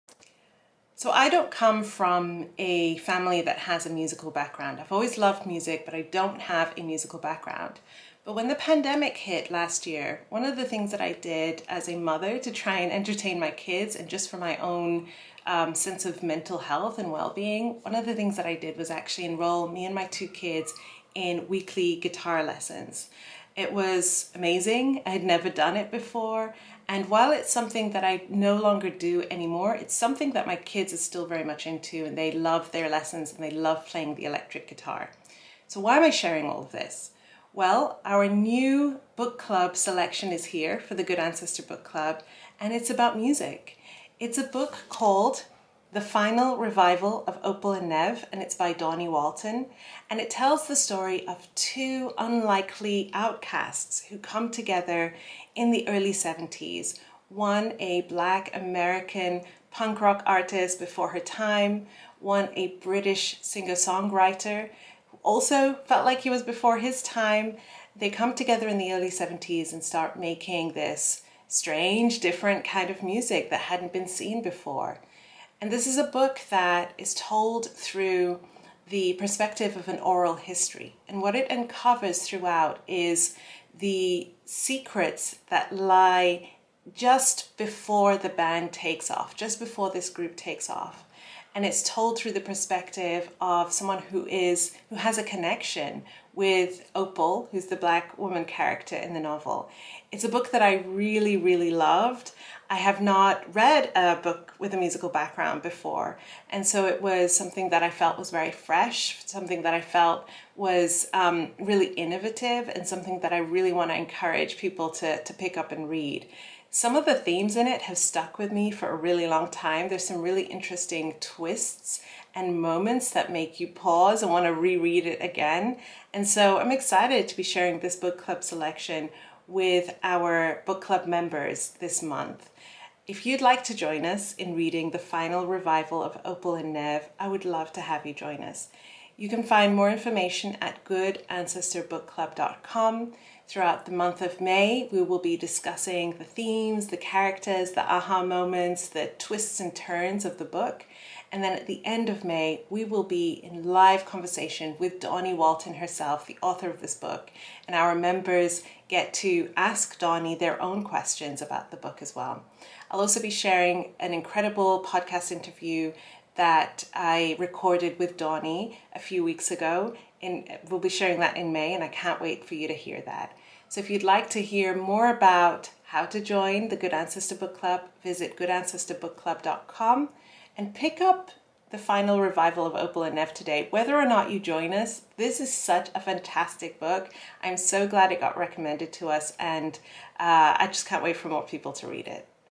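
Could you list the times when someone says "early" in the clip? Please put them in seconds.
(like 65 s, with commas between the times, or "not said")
55 s, 68 s.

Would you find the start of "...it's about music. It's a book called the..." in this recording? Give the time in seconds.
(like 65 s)
42 s.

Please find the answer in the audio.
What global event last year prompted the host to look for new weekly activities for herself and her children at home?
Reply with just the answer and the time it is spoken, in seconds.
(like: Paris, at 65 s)
The pandemic, at 8 s.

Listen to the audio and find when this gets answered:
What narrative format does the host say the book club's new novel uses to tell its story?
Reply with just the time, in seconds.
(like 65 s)
79 s.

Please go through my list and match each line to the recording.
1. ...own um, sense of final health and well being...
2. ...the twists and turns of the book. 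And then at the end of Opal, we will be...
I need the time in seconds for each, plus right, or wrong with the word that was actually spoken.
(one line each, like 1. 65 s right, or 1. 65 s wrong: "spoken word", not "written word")
1. 14 s wrong: "mental", not "final"
2. 148 s wrong: "May", not "Opal".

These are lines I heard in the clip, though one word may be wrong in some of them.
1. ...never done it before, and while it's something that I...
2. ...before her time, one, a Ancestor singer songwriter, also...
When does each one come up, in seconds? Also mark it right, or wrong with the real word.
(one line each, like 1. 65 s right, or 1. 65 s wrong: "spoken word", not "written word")
1. 25 s right
2. 60 s wrong: "British", not "Ancestor".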